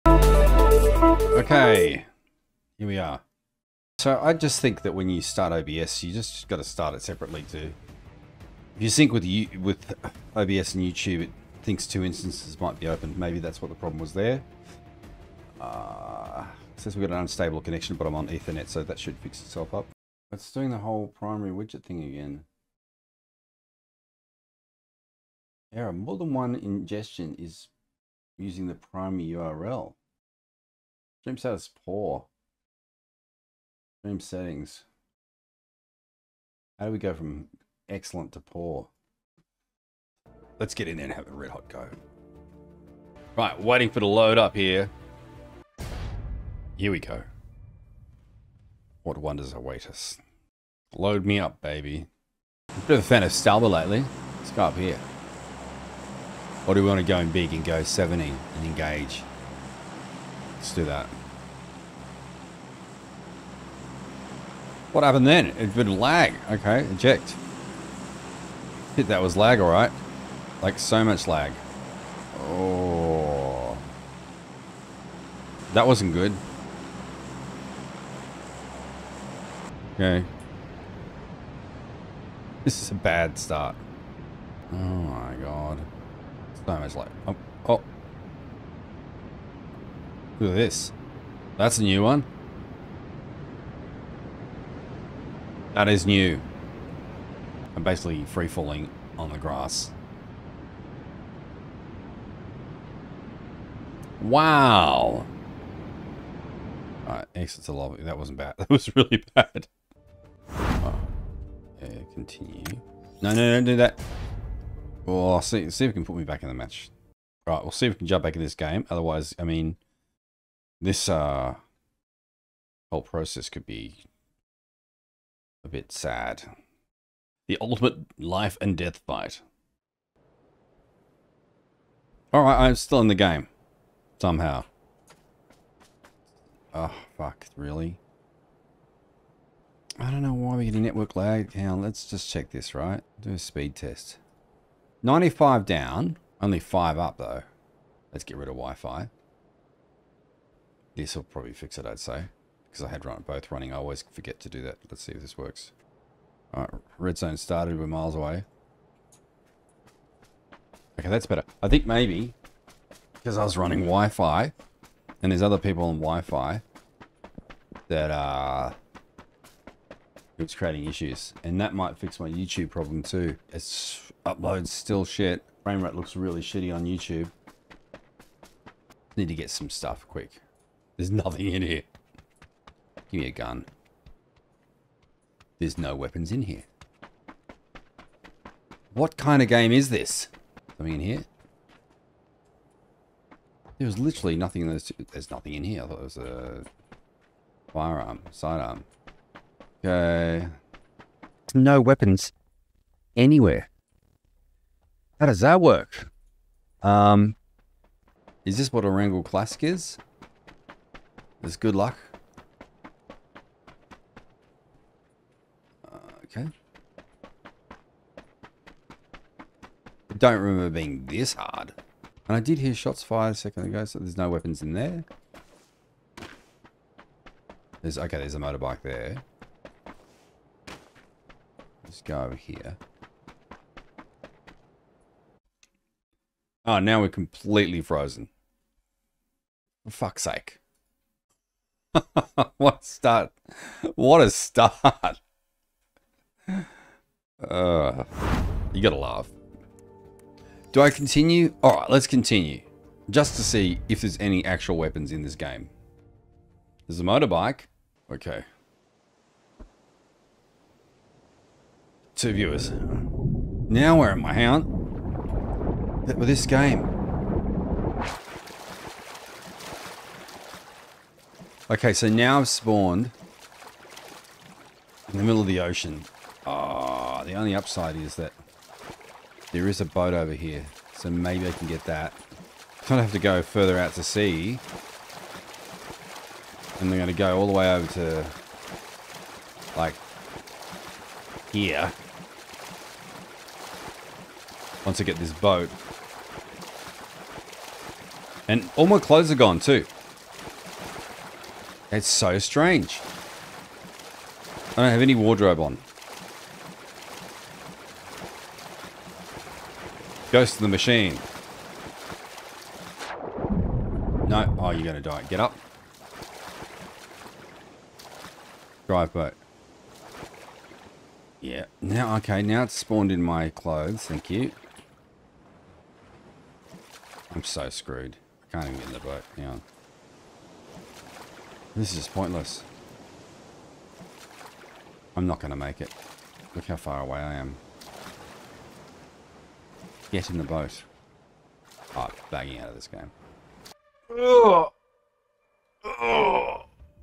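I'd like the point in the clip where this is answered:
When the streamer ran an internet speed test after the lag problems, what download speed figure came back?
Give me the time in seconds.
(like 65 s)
145 s.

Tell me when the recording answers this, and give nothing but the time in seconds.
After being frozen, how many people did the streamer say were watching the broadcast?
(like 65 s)
262 s.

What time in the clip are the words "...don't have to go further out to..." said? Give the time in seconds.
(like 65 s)
282 s.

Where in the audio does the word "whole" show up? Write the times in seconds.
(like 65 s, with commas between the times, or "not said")
20 s, 122 s.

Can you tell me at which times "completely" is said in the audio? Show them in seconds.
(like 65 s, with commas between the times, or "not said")
237 s.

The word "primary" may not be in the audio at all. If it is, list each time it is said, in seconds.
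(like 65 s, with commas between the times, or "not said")
21 s, 28 s.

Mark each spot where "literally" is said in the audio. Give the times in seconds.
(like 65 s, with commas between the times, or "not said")
193 s.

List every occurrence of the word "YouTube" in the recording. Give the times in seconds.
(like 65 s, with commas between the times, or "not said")
10 s, 172 s, 176 s.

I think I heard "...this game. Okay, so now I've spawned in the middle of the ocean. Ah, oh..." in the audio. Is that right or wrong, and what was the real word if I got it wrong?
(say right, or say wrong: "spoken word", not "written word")
right.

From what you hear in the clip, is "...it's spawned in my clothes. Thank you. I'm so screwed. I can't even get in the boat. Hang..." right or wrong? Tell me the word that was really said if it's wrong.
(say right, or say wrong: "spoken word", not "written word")
right.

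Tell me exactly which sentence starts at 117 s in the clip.
Right, we'll see if we can jump back in this game.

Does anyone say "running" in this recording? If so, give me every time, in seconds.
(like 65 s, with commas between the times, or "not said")
153 s, 163 s.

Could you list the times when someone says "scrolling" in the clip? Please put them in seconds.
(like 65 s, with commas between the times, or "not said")
not said.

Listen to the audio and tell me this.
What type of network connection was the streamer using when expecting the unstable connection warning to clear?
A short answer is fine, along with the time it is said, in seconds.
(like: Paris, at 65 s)
Ethernet, at 18 s.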